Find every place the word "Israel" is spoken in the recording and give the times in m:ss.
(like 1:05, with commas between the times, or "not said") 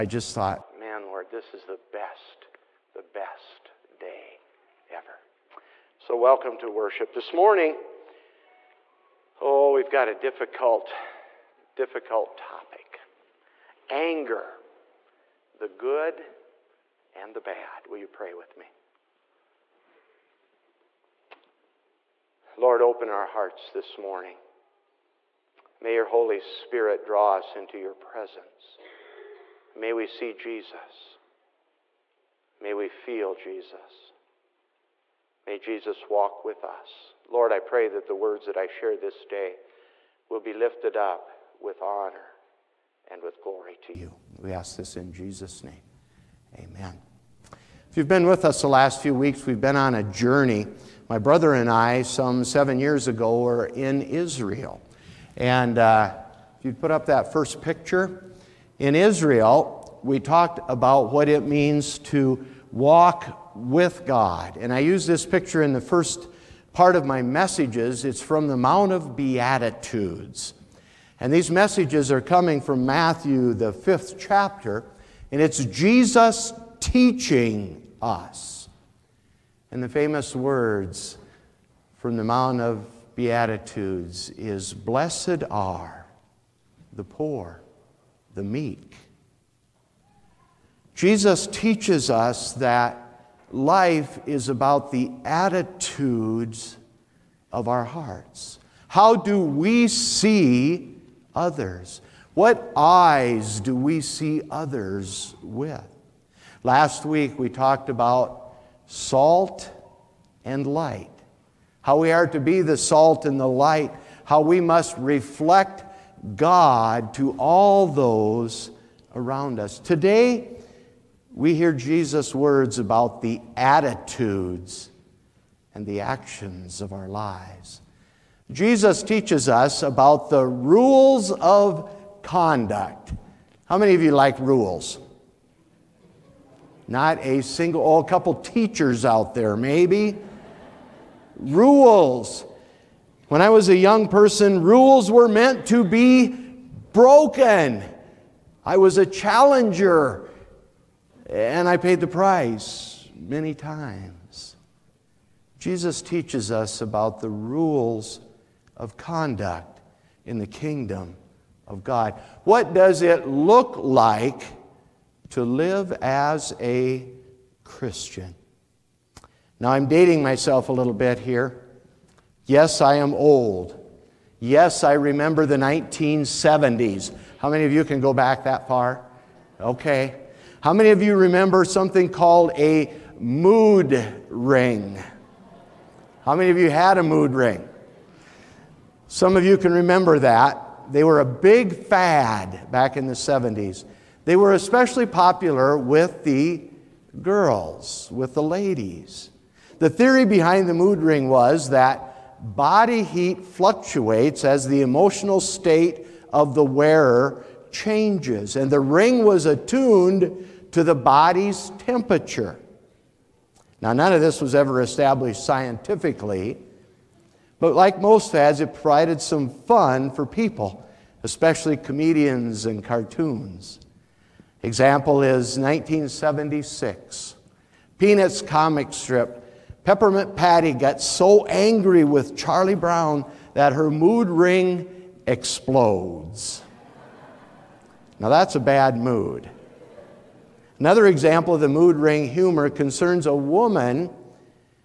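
0:54, 0:58.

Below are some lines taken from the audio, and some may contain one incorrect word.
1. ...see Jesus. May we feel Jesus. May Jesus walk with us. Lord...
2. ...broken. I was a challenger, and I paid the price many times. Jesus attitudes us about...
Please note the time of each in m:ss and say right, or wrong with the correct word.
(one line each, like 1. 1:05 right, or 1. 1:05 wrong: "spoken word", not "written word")
1. 0:30 right
2. 2:26 wrong: "teaches", not "attitudes".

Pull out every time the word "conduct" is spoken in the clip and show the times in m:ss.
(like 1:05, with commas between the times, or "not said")
2:12, 2:38.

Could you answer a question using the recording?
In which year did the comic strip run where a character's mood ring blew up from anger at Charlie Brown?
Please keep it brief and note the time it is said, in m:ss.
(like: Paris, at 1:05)
1976, at 3:45.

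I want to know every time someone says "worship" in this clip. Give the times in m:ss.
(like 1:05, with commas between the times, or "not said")
0:06.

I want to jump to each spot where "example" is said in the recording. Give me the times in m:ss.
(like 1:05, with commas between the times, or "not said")
3:44, 4:01.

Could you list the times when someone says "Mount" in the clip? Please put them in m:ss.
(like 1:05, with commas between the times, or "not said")
1:08, 1:22.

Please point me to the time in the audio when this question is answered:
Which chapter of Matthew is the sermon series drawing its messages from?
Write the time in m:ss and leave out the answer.
1:13.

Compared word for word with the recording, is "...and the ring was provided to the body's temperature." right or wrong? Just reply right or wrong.
wrong.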